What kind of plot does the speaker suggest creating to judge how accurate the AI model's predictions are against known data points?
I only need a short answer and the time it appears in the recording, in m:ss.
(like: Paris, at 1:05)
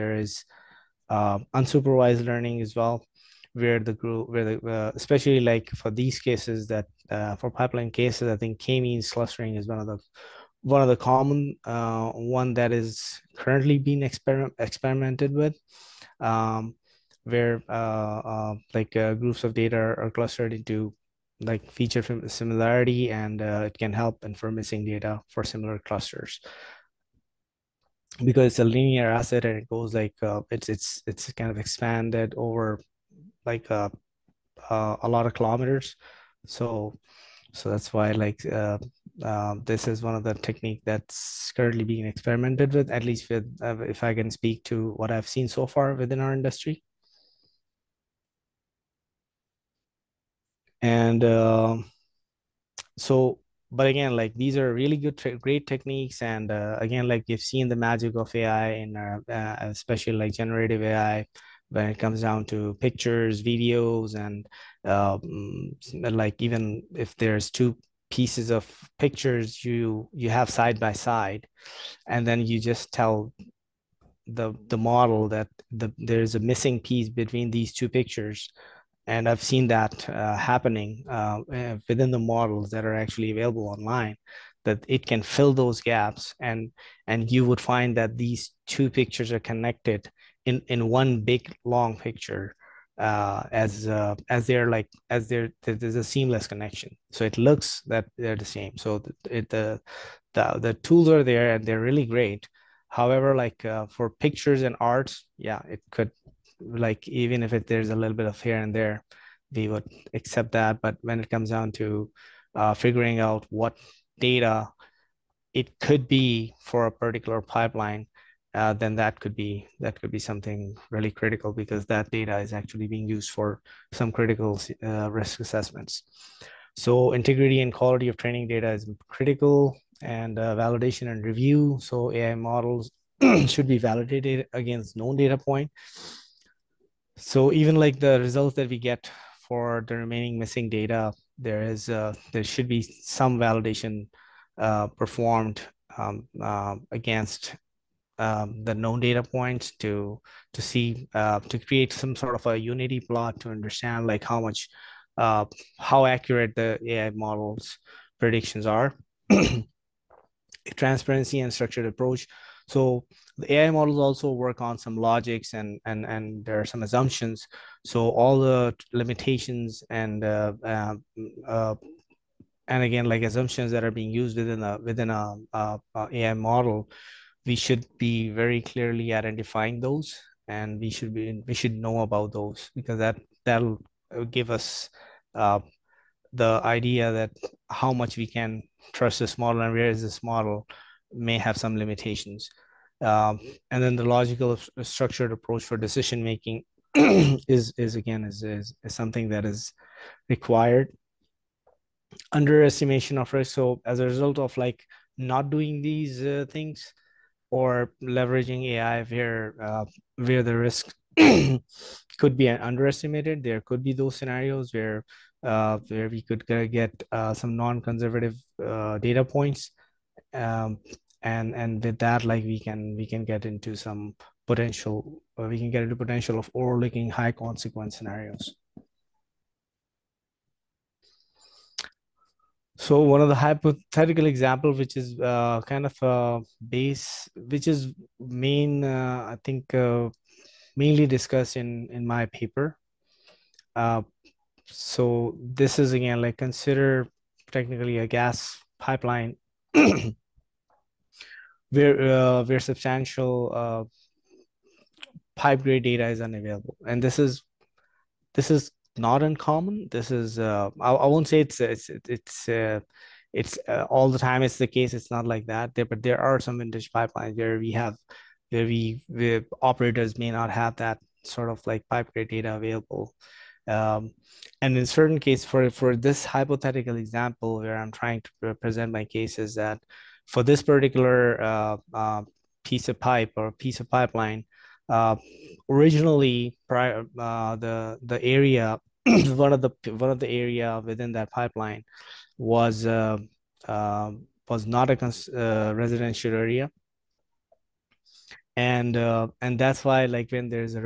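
unity plot, at 2:32.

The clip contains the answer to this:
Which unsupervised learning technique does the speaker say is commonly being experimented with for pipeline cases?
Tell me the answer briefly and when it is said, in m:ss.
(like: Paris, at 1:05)
k-means clustering, at 0:08.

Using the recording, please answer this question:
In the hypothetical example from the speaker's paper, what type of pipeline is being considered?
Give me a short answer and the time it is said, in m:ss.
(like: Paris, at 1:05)
gas pipeline, at 4:08.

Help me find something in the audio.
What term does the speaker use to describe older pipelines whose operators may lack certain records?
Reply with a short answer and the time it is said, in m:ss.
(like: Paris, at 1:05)
vintage pipelines, at 4:26.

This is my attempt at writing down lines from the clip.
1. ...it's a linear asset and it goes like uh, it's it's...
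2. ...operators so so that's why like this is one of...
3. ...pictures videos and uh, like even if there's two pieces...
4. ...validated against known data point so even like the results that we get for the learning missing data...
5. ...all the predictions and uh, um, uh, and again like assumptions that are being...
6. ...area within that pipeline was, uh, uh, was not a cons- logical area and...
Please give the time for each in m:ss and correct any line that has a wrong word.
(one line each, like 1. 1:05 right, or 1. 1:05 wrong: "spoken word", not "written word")
1. 0:28 right
2. 0:35 wrong: "kilometers", not "operators"
3. 1:02 right
4. 2:13 wrong: "remaining", not "learning"
5. 2:48 wrong: "limitations", not "predictions"
6. 4:50 wrong: "residential", not "logical".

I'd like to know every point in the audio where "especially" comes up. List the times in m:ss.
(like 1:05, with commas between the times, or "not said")
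0:04, 0:59.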